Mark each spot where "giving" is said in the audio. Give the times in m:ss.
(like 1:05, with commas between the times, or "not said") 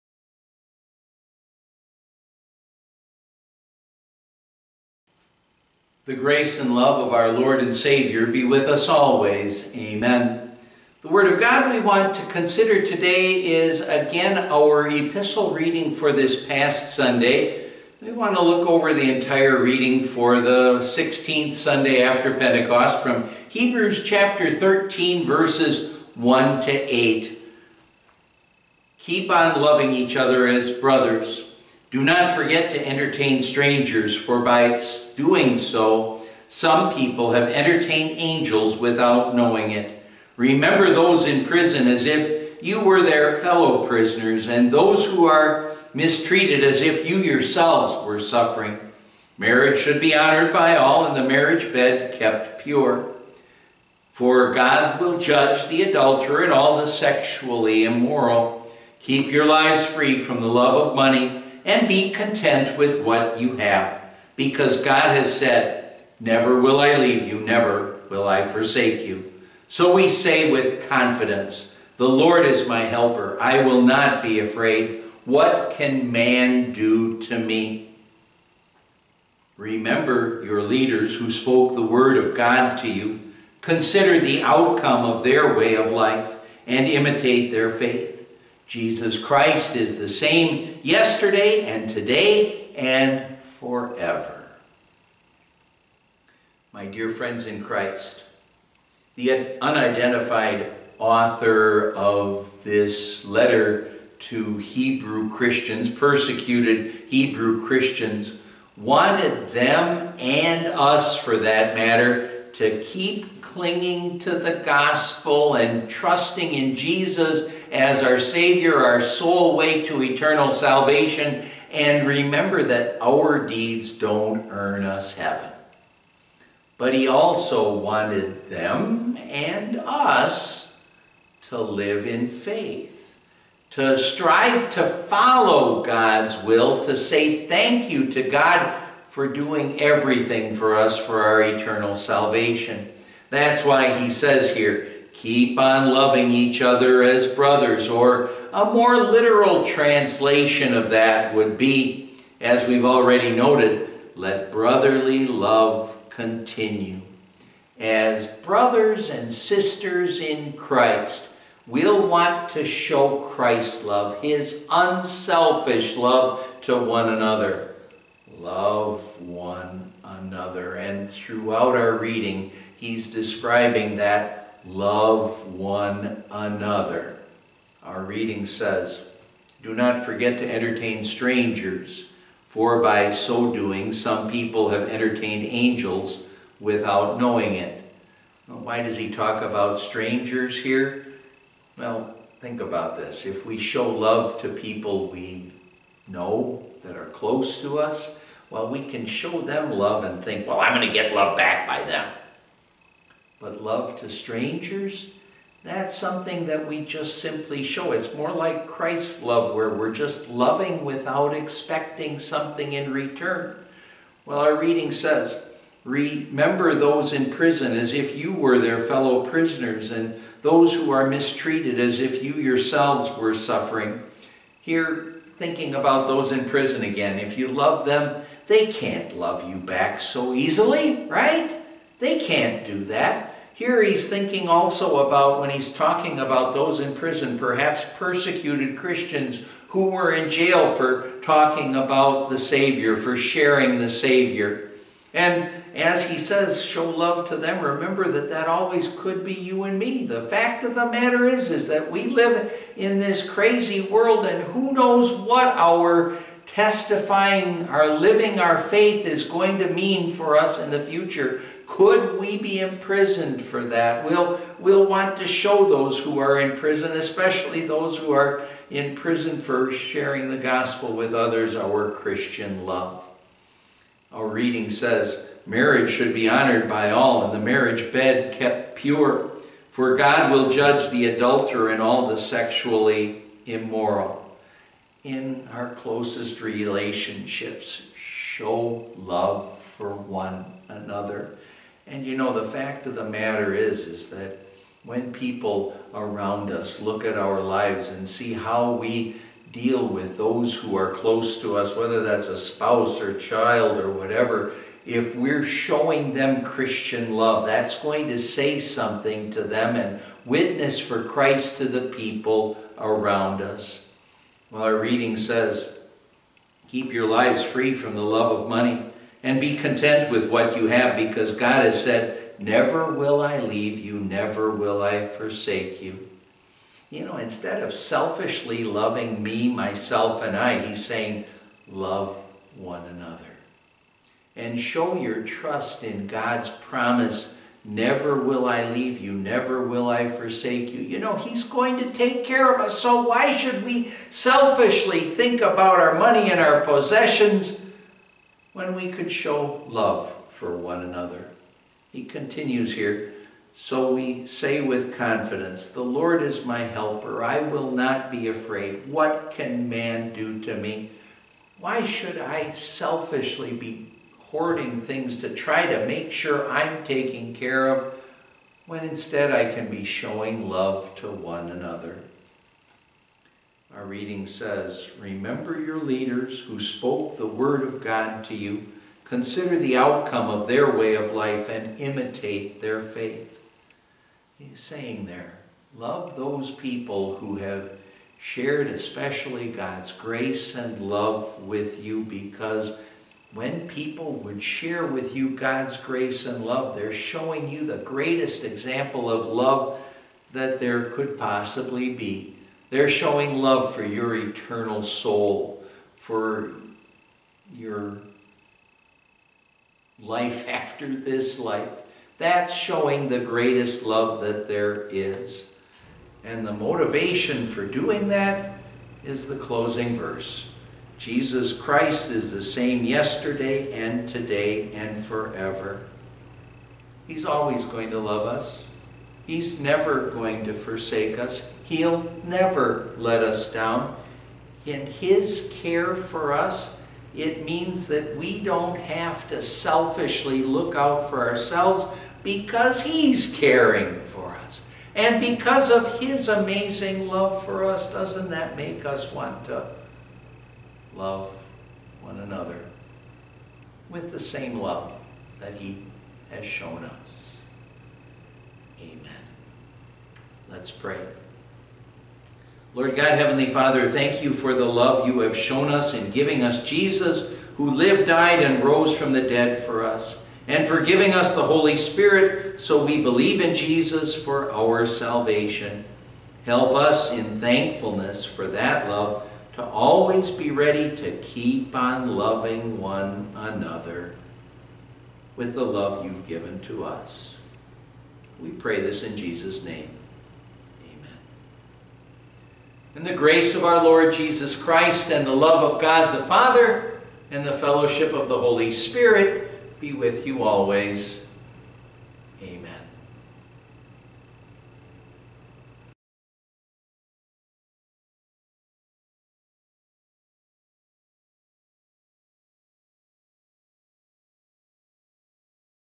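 7:46, 7:50.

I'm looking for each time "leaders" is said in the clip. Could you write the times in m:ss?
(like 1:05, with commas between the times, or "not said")
1:20, 6:15.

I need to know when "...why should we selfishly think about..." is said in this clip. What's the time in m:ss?
5:43.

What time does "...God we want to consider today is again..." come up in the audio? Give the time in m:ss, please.
0:11.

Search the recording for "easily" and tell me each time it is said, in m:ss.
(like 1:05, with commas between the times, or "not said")
3:50.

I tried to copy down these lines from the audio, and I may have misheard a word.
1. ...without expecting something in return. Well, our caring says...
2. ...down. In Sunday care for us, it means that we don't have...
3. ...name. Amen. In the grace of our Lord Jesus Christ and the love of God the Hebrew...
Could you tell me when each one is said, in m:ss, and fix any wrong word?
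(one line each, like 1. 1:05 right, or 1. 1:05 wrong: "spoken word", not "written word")
1. 3:30 wrong: "reading", not "caring"
2. 7:13 wrong: "His", not "Sunday"
3. 8:09 wrong: "Father", not "Hebrew".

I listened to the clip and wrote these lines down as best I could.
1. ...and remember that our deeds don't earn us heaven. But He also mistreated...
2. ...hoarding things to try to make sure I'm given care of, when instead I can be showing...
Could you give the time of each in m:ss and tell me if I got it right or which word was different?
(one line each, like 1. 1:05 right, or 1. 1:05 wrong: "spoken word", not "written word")
1. 2:01 wrong: "wanted", not "mistreated"
2. 6:04 wrong: "taken", not "given".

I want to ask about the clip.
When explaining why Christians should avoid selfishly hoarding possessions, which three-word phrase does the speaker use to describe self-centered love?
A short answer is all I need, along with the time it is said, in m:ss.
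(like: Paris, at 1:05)
Me, myself, and I, at 5:29.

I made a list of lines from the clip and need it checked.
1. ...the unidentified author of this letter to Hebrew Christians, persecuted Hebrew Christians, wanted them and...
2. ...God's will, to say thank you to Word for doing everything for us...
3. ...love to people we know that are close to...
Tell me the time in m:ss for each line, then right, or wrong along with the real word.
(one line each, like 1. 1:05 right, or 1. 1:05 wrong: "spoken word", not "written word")
1. 1:39 right
2. 2:15 wrong: "God", not "Word"
3. 3:13 right.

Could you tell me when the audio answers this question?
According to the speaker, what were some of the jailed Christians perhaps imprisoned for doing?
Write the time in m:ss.
4:01.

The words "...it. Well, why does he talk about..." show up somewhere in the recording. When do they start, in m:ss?
3:07.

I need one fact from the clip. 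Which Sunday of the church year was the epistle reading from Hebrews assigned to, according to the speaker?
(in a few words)
16th Sunday after Pentecost.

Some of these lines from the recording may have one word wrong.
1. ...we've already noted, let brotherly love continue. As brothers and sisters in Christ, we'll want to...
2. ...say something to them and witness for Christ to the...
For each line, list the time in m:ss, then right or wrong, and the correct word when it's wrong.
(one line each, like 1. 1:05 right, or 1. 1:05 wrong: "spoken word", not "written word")
1. 2:32 right
2. 5:08 right.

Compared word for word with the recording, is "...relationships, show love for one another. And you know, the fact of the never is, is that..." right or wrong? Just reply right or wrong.
wrong.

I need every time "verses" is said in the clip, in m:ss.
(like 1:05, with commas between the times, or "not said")
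0:25, 6:59.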